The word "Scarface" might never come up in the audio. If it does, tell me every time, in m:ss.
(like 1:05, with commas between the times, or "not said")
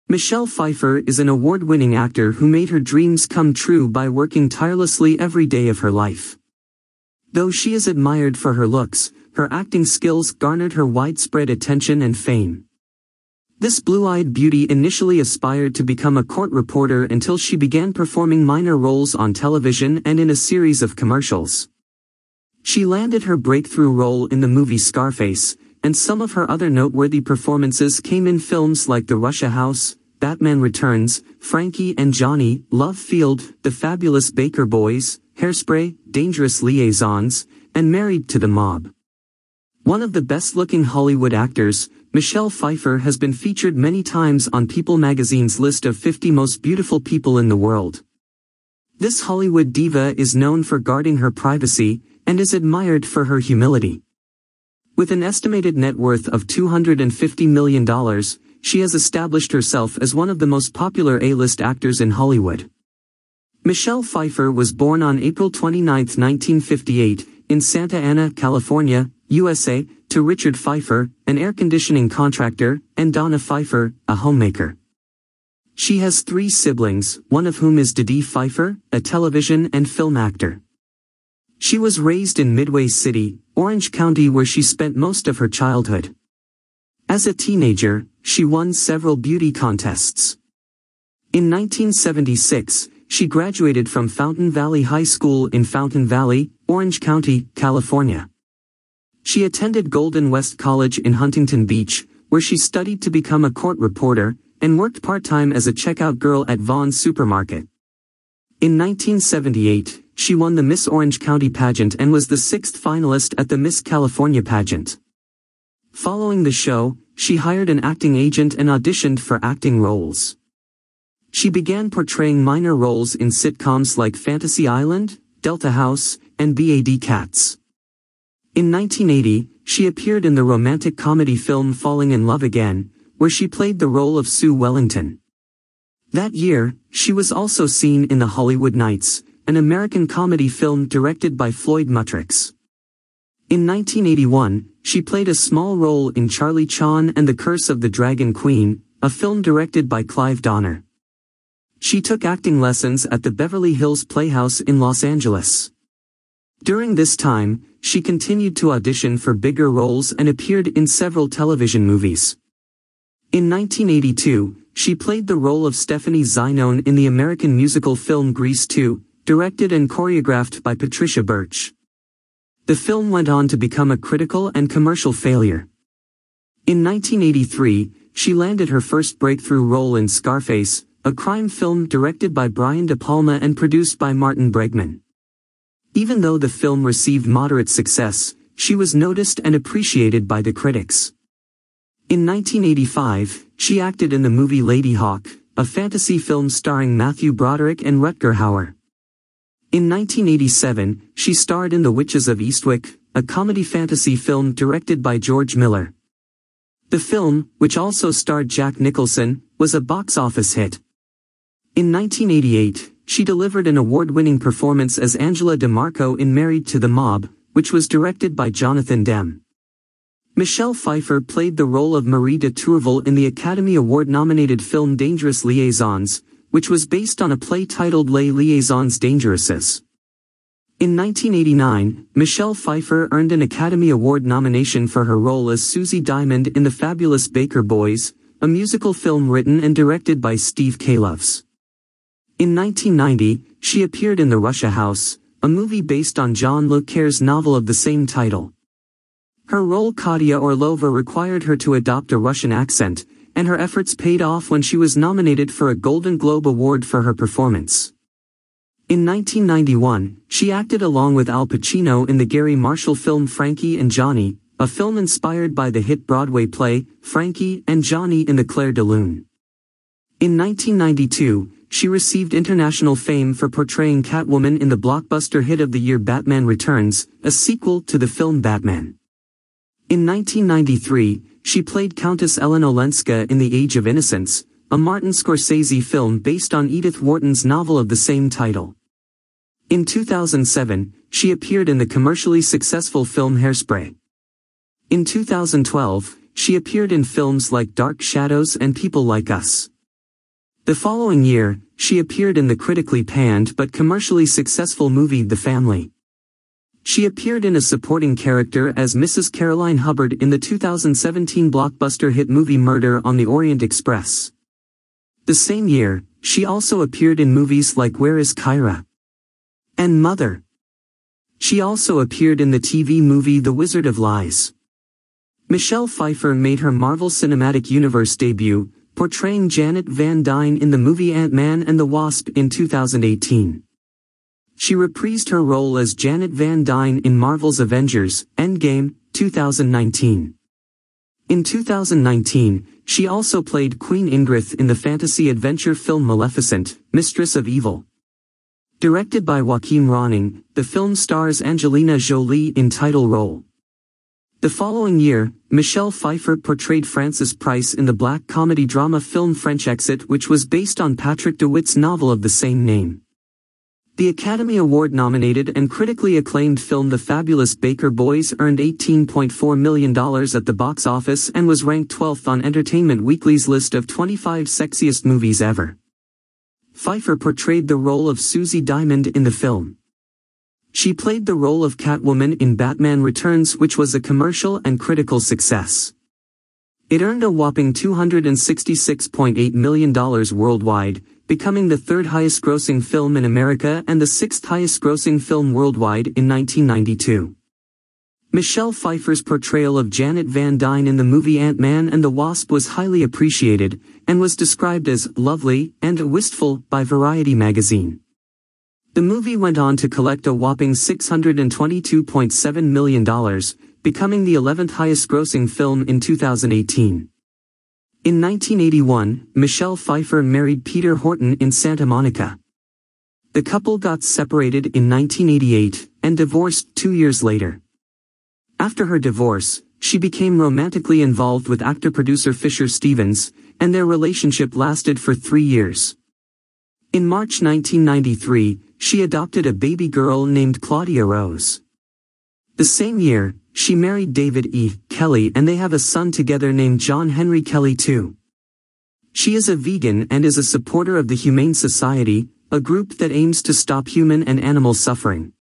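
0:24, 3:00.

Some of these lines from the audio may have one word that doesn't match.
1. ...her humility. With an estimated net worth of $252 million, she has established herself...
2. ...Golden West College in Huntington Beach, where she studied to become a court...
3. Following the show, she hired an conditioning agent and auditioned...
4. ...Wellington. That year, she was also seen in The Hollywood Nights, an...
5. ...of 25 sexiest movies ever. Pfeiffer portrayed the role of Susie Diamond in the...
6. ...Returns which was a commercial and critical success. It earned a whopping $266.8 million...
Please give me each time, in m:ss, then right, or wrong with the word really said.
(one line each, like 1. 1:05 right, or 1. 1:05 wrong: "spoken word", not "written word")
1. 0:53 wrong: "250", not "252"
2. 1:39 right
3. 1:55 wrong: "acting", not "conditioning"
4. 2:14 right
5. 6:13 right
6. 6:23 right.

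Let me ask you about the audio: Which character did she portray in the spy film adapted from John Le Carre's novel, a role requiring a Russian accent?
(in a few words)
Katia Orlova.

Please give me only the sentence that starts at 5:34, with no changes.
She reprised her role as Janet Van Dyne in Marvel's Avengers, Endgame, 2019.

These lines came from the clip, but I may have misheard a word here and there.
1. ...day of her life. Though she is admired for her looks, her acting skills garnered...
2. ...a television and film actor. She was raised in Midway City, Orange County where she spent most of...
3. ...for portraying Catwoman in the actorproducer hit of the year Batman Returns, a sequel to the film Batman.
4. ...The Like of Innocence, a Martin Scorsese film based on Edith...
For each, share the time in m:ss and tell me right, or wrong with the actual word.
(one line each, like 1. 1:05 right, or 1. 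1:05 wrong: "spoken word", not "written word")
1. 0:05 right
2. 1:18 right
3. 4:33 wrong: "blockbuster", not "actorproducer"
4. 4:43 wrong: "Age", not "Like".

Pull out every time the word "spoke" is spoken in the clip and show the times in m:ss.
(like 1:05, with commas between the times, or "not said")
not said.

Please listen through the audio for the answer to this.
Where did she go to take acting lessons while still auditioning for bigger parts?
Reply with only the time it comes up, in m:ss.
2:33.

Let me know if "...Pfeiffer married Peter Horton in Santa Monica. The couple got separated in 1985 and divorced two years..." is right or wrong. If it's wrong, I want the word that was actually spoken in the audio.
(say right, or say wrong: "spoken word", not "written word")
wrong: "1988", not "1985".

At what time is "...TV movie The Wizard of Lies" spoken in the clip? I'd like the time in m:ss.
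5:22.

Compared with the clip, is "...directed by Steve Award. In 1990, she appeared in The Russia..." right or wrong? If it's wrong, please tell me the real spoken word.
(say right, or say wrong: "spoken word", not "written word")
wrong: "Kloves", not "Award".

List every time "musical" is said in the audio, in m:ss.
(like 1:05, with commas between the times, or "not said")
2:47, 3:58.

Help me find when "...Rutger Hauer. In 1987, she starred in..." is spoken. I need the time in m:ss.
3:18.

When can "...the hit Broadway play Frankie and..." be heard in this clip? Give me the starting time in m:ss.
4:25.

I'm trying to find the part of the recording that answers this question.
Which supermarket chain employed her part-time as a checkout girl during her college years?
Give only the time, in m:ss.
1:46.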